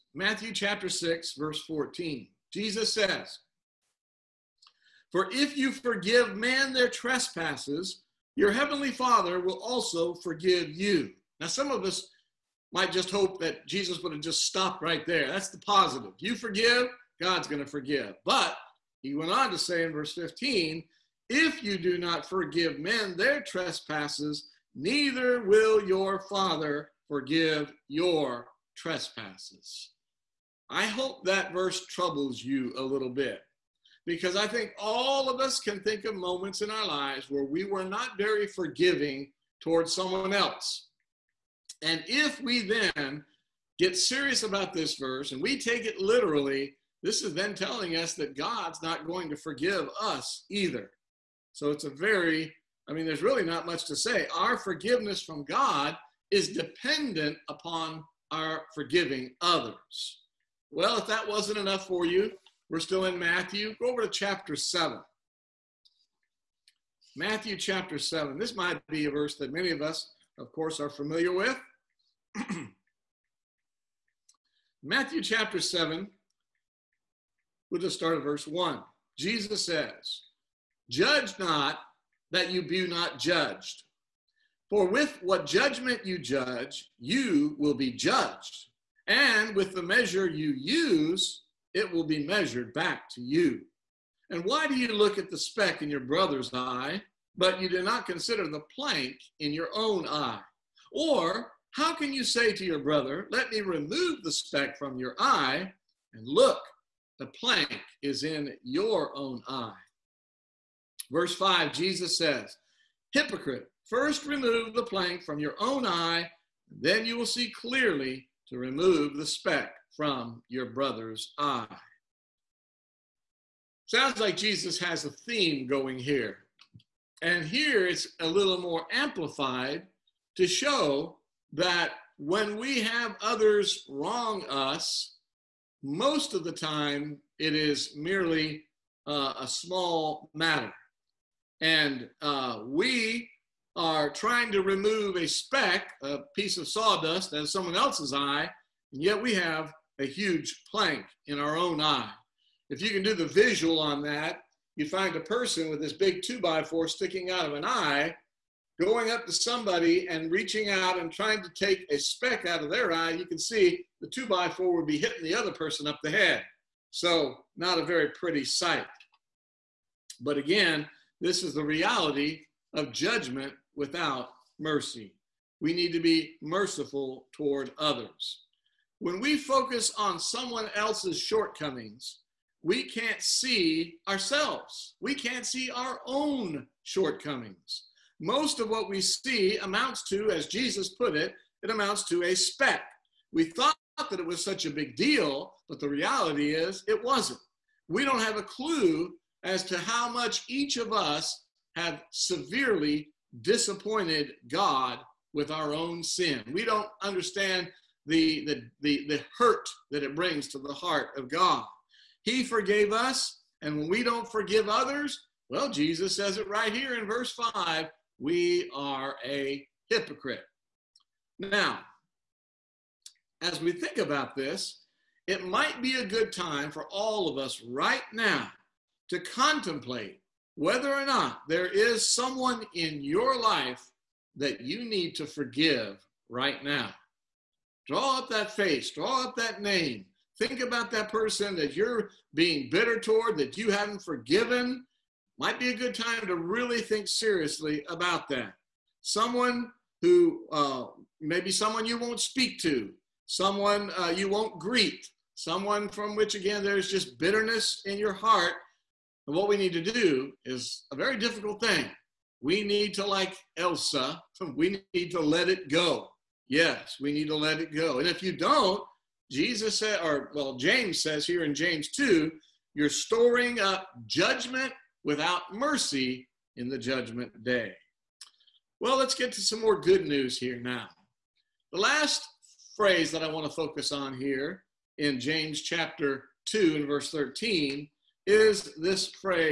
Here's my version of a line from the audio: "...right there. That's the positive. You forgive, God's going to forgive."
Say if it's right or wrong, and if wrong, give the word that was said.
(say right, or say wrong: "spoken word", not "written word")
right.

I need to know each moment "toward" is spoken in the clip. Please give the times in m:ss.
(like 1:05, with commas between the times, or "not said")
0:39, 2:57, 4:02.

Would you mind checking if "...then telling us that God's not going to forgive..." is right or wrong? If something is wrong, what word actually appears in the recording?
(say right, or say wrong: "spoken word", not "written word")
right.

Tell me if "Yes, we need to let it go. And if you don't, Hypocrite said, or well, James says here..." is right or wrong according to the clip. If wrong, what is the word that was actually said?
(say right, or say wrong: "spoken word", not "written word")
wrong: "Jesus", not "Hypocrite".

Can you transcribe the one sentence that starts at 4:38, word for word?
Well, let's get to some more good news here now.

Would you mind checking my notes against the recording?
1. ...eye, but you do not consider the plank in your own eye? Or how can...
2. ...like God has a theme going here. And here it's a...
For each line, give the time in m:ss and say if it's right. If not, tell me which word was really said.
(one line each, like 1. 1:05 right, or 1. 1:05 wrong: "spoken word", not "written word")
1. 1:36 right
2. 2:04 wrong: "Jesus", not "God".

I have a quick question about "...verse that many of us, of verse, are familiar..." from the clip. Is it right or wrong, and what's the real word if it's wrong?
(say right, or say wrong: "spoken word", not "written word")
wrong: "course", not "verse".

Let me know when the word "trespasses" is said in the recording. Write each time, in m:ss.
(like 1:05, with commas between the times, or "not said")
0:06, 0:23, 0:28.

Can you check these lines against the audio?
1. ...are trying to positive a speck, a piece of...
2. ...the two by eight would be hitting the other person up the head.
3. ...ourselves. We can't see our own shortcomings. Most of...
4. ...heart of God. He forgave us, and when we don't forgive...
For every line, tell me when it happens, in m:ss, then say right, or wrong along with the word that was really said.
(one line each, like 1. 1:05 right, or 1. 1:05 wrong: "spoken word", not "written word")
1. 2:23 wrong: "remove", not "positive"
2. 2:44 wrong: "four", not "eight"
3. 3:04 right
4. 3:30 right.